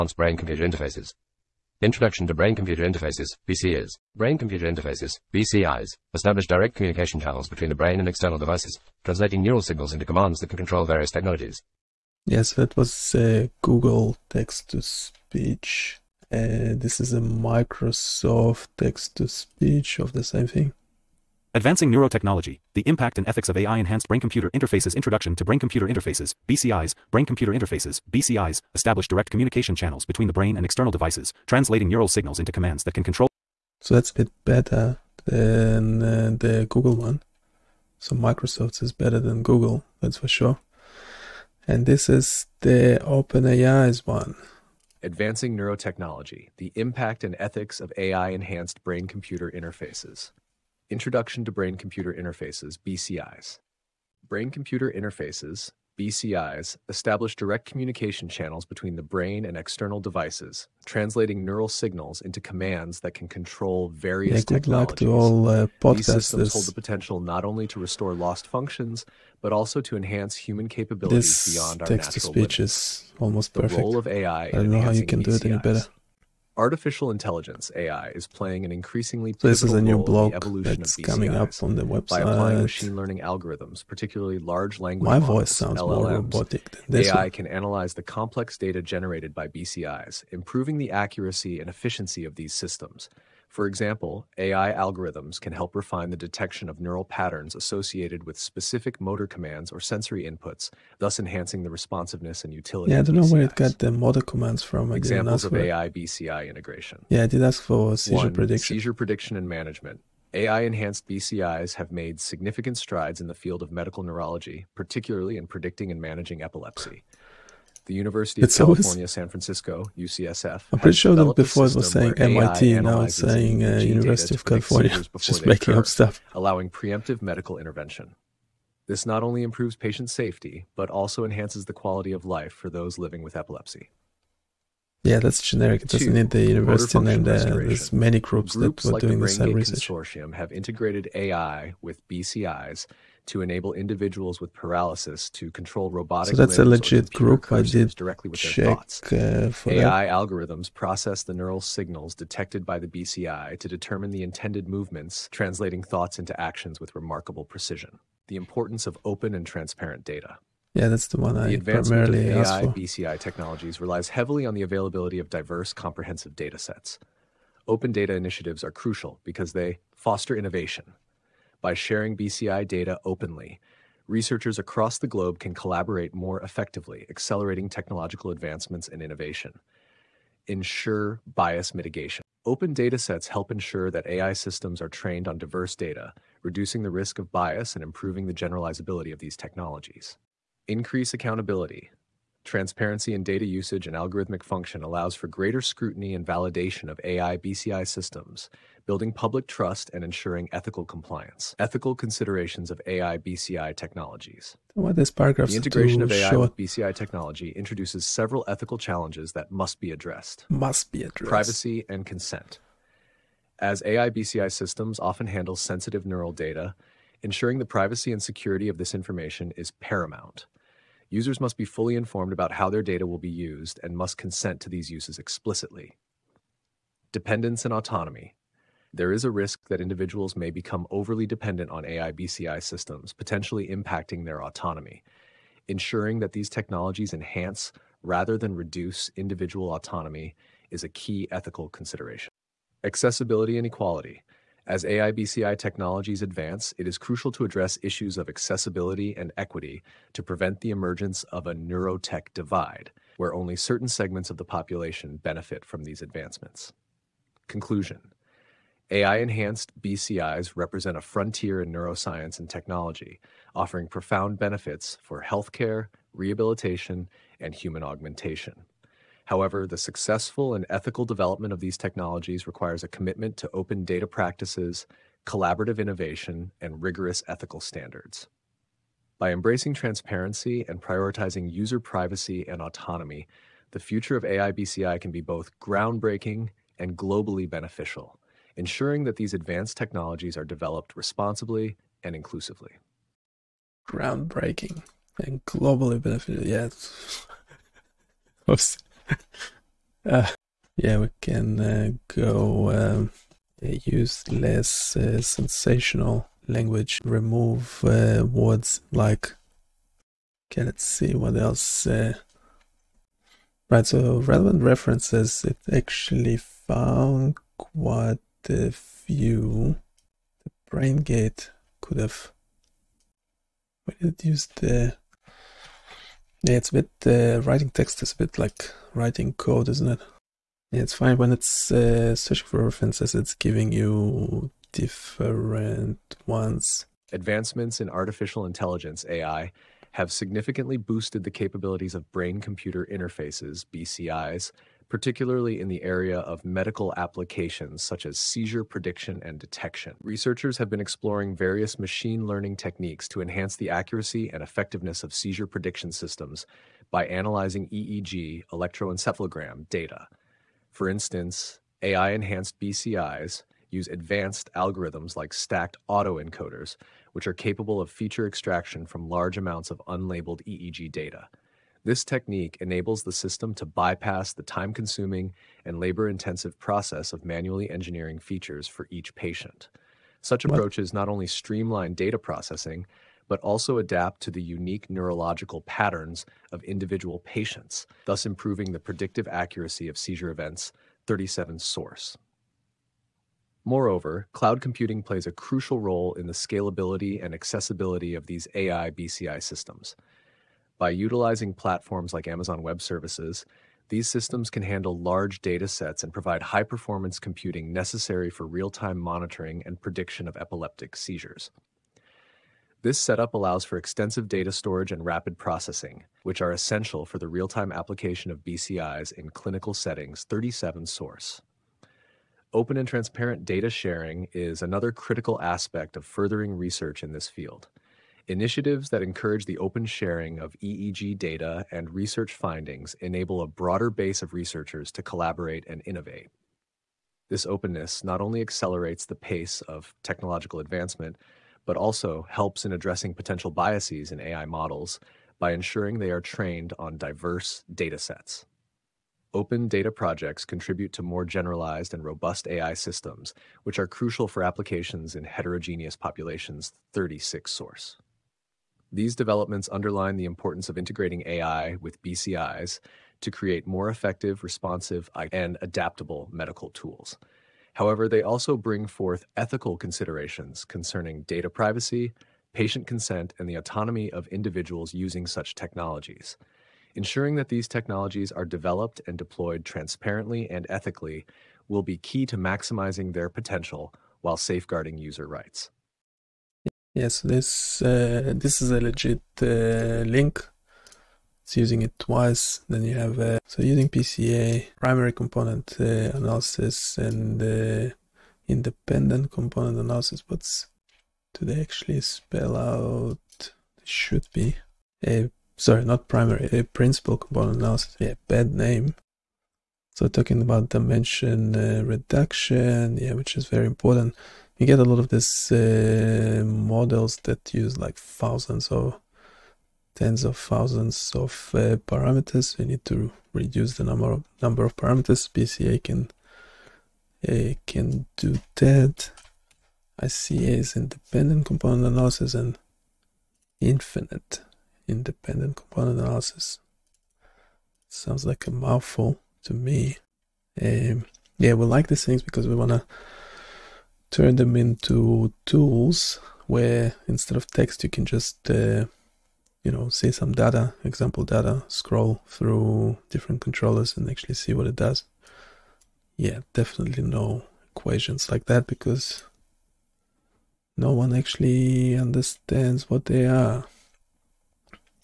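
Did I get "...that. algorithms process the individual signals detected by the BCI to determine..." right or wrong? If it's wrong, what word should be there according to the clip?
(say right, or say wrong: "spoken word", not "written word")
wrong: "neural", not "individual".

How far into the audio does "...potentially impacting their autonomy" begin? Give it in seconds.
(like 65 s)
233 s.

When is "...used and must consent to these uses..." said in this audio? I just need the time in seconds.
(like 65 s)
223 s.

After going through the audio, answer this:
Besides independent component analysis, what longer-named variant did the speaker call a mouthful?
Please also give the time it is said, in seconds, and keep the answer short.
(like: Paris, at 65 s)
infinite independent component analysis, at 533 s.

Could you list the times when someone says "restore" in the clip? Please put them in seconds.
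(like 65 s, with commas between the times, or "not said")
67 s.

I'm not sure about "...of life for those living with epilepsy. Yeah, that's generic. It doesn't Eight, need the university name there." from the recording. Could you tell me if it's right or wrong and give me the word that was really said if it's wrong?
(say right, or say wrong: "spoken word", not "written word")
wrong: "Two", not "Eight".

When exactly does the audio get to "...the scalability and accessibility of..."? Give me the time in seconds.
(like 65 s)
396 s.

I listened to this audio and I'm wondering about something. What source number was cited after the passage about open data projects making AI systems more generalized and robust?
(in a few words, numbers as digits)
36.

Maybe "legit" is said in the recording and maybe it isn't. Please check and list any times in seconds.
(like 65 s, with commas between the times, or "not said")
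146 s, 488 s.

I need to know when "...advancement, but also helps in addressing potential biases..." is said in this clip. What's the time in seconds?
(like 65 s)
440 s.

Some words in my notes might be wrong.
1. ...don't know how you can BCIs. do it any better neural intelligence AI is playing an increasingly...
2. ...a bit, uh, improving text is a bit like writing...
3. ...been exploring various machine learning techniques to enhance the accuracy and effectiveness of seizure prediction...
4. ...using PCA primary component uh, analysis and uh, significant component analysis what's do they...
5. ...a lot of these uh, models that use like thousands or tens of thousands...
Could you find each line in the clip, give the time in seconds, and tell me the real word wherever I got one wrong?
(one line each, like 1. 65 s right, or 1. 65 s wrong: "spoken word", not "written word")
1. 74 s wrong: "artificial", not "neural"
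2. 326 s wrong: "writing", not "improving"
3. 350 s right
4. 493 s wrong: "independent", not "significant"
5. 514 s right.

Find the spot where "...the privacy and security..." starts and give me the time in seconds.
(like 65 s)
217 s.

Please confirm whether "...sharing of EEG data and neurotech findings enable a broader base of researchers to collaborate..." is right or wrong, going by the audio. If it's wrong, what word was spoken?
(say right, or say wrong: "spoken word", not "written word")
wrong: "research", not "neurotech".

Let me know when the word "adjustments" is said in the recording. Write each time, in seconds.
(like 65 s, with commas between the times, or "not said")
not said.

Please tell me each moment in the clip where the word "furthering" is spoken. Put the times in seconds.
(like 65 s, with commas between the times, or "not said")
426 s.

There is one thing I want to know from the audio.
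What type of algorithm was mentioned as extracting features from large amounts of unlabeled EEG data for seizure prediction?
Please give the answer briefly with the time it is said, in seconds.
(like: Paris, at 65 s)
stacked autoencoders, at 365 s.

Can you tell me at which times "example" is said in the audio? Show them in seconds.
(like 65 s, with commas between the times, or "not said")
93 s, 104 s, 550 s.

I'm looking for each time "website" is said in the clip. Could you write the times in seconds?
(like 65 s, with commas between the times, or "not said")
81 s.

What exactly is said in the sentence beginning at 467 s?
However, they also bring forth ethical considerations concerning data privacy, patient consent, and the autonomy of individuals using such technologies.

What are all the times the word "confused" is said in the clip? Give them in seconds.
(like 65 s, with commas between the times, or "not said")
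not said.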